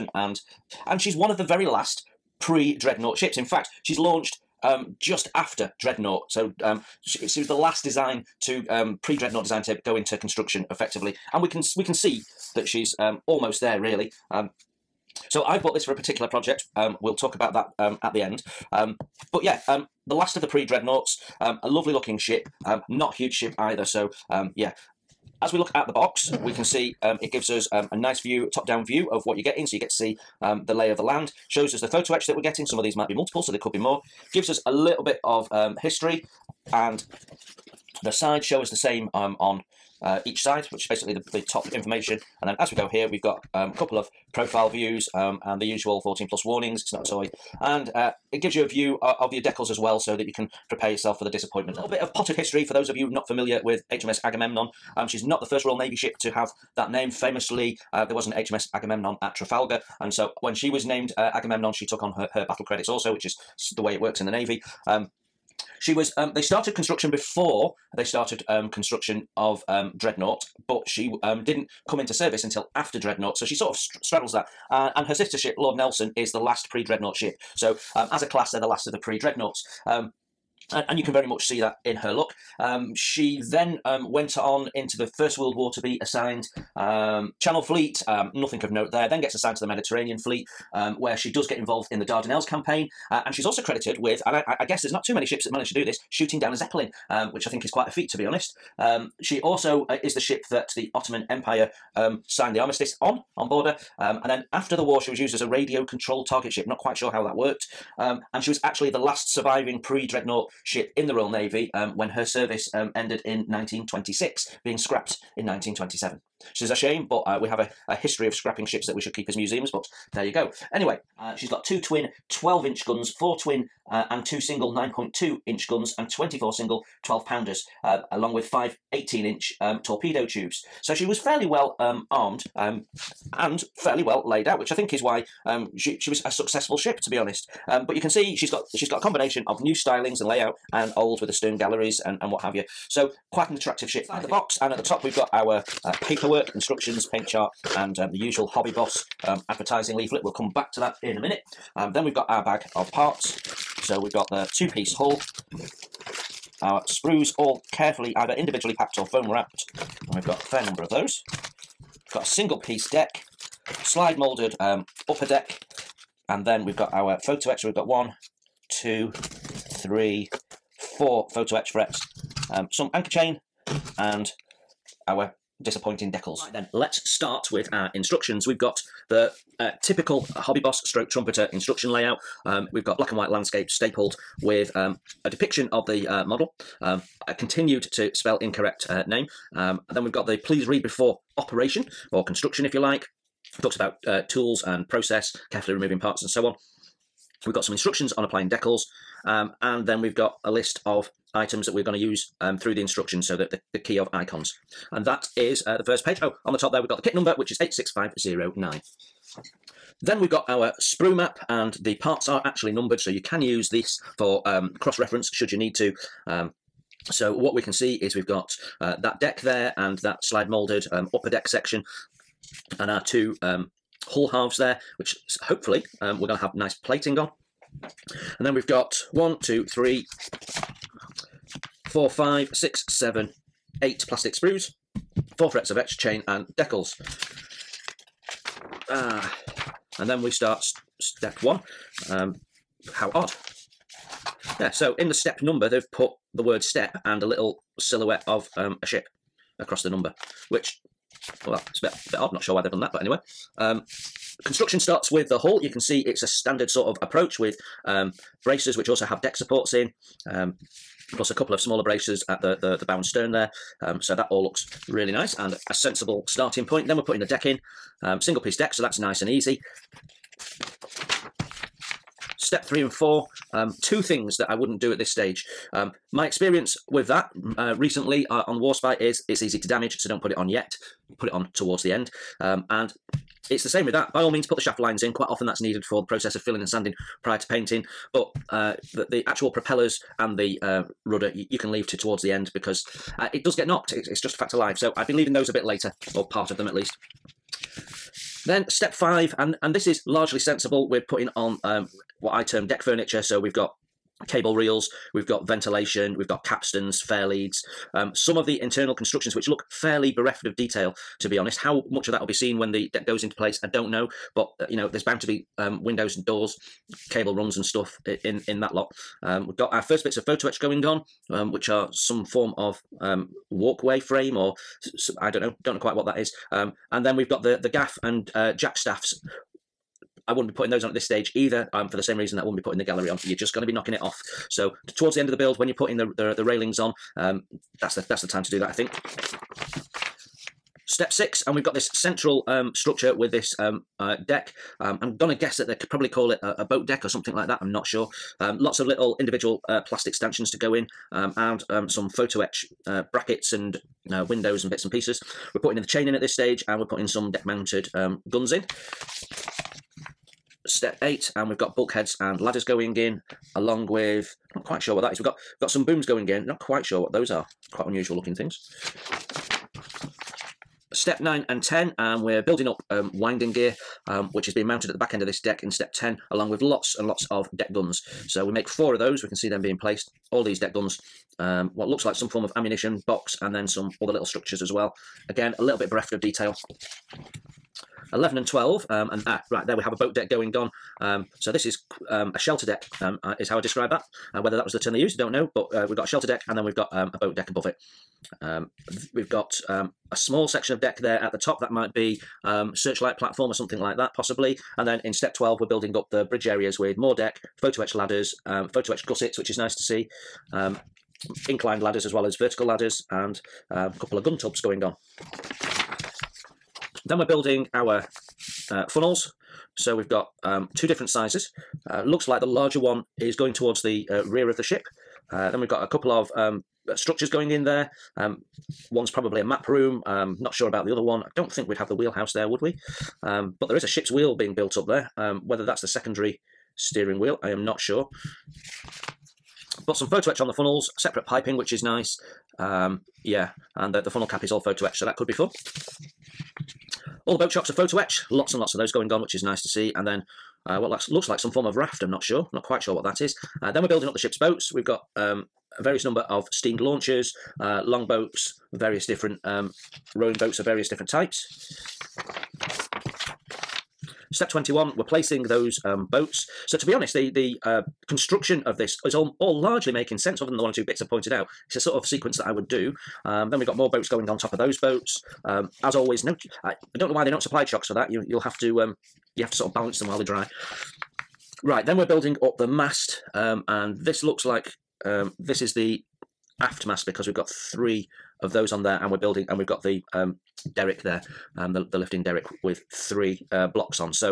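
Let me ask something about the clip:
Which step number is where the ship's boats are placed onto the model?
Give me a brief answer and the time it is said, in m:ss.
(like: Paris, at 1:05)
21, at 7:44.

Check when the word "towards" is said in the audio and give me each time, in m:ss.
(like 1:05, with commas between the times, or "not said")
4:41, 4:51, 5:34, 7:03.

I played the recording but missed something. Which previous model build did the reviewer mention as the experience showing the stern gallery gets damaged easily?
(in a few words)
Warspite.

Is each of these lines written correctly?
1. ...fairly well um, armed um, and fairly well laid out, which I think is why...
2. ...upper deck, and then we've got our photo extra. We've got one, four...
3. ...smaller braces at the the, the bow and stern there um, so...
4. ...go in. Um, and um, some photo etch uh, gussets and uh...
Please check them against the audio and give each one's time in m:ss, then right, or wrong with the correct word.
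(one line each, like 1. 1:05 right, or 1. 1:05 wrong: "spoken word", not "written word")
1. 2:11 right
2. 2:45 wrong: "two", not "four"
3. 4:21 right
4. 5:50 wrong: "brackets", not "gussets".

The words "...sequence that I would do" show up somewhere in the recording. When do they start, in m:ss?
7:52.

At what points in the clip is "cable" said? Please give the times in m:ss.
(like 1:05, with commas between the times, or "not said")
5:04, 5:17.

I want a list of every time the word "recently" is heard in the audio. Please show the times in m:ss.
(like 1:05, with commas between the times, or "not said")
4:37.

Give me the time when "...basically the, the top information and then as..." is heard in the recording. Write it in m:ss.
0:40.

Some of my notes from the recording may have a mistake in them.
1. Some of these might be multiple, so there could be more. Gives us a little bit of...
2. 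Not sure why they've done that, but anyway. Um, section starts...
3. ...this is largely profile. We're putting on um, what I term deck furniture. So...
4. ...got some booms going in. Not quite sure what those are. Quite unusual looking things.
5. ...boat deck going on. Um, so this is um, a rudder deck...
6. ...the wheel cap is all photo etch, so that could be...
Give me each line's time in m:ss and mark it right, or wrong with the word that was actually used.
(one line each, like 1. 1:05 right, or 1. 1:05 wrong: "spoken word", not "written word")
1. 0:32 right
2. 4:12 wrong: "construction", not "section"
3. 4:59 wrong: "sensible", not "profile"
4. 6:05 right
5. 6:29 wrong: "shelter", not "rudder"
6. 7:24 wrong: "funnel", not "wheel".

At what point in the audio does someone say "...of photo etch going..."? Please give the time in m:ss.
5:20.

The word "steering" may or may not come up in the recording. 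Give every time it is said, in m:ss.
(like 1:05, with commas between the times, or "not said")
7:16.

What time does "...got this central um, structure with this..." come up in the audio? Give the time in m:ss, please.
5:41.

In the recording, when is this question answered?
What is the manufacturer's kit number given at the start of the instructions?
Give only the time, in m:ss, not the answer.
3:27.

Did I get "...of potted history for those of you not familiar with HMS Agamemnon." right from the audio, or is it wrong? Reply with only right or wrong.
right.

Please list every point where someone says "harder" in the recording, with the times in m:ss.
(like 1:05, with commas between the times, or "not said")
not said.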